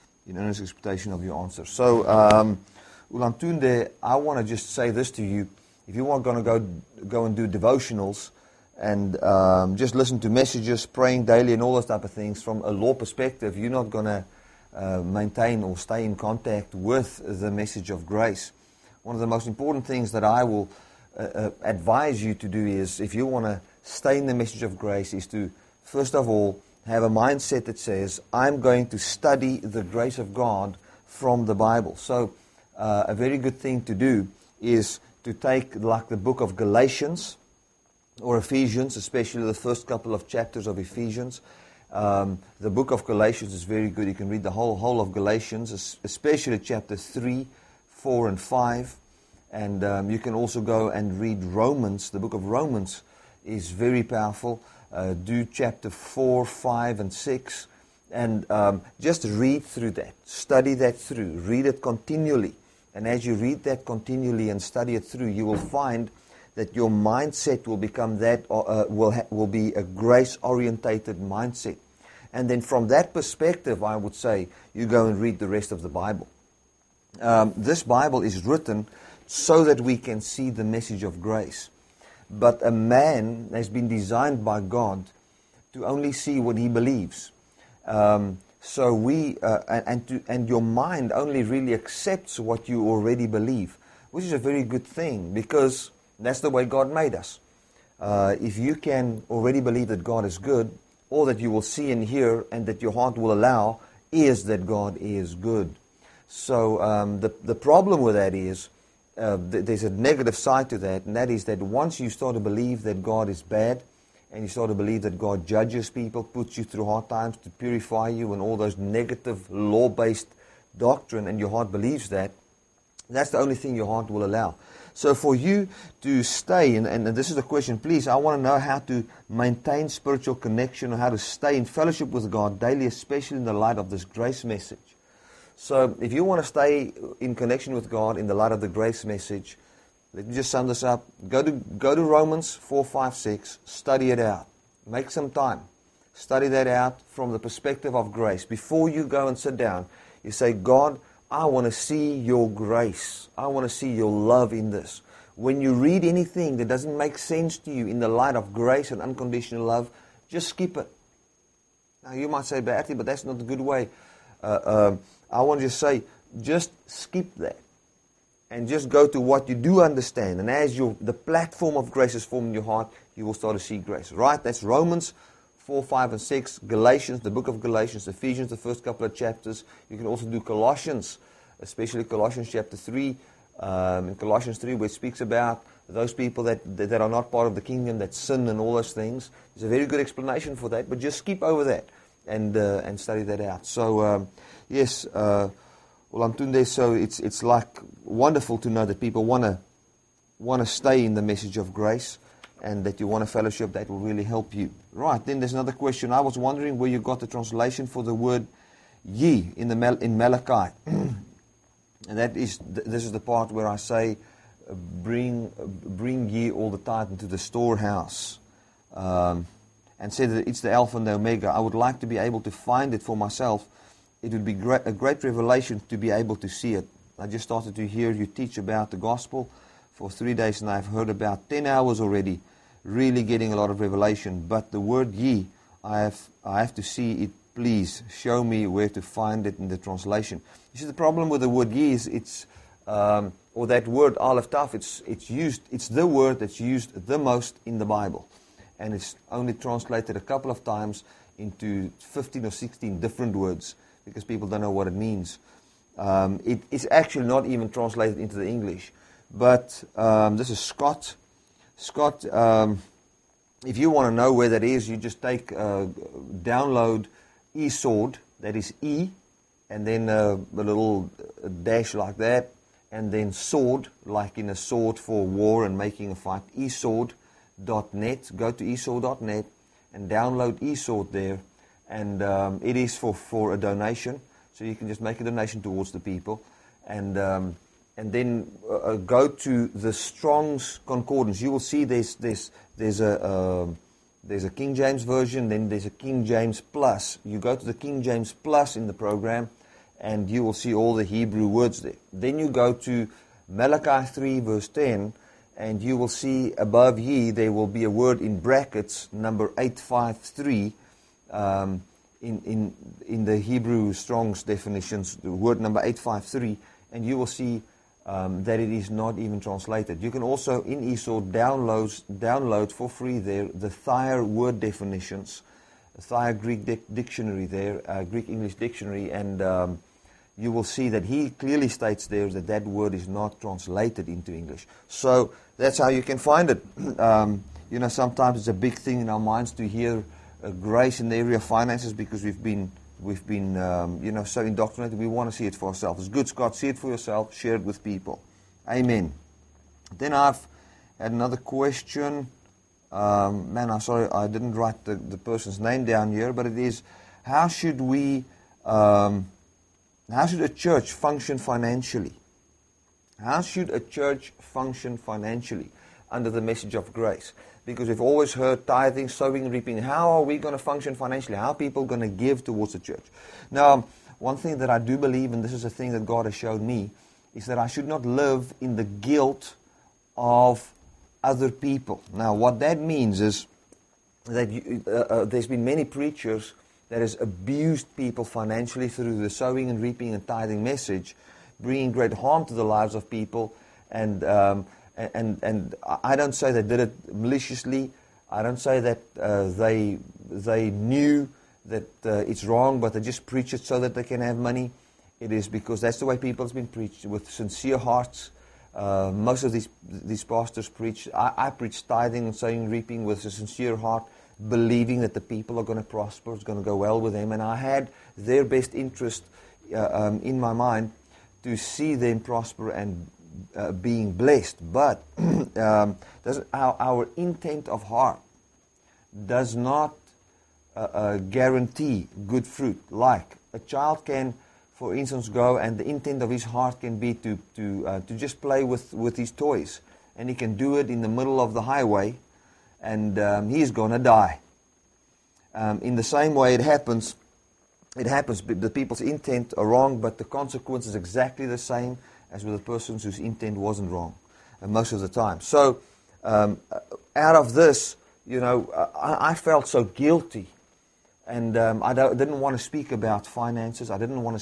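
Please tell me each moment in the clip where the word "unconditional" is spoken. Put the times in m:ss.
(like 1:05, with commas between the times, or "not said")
2:39.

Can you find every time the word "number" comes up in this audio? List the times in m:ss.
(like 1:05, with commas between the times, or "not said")
5:09, 5:15.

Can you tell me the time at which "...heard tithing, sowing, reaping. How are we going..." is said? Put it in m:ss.
6:08.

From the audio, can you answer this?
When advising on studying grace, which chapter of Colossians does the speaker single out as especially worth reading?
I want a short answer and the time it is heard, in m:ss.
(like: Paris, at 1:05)
Chapter 3, at 3:02.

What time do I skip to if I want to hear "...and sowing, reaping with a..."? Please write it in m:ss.
6:52.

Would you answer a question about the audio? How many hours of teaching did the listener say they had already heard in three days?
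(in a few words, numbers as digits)
10 hours.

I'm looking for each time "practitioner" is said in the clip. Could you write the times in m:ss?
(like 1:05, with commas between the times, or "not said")
not said.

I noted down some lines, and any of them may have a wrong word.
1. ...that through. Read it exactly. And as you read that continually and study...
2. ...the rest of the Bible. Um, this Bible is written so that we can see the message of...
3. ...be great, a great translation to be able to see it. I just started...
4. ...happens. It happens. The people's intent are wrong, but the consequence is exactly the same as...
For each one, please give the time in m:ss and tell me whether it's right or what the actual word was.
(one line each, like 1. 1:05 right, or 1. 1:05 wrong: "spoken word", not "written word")
1. 1:00 wrong: "continually", not "exactly"
2. 1:15 right
3. 3:44 wrong: "revelation", not "translation"
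4. 7:26 right.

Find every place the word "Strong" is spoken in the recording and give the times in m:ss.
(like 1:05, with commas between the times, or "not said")
4:49, 5:13.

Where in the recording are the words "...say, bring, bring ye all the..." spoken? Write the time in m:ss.
3:33.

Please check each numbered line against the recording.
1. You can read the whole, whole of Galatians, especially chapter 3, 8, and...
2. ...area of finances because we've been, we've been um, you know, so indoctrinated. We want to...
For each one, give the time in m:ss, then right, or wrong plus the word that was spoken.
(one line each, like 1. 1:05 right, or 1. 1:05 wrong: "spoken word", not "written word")
1. 0:44 wrong: "4", not "8"
2. 5:41 right.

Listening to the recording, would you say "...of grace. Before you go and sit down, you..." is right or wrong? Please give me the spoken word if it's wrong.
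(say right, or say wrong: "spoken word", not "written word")
right.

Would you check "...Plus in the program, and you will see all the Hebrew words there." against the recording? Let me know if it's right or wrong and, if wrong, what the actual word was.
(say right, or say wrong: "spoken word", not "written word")
right.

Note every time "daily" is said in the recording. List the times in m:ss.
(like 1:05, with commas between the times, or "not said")
0:11, 2:12.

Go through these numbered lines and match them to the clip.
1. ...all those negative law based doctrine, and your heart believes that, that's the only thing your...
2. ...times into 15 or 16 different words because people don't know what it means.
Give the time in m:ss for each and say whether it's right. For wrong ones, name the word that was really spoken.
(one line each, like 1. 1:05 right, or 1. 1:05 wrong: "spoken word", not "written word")
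1. 1:58 right
2. 4:10 right.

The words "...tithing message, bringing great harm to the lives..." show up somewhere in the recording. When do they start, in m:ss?
6:30.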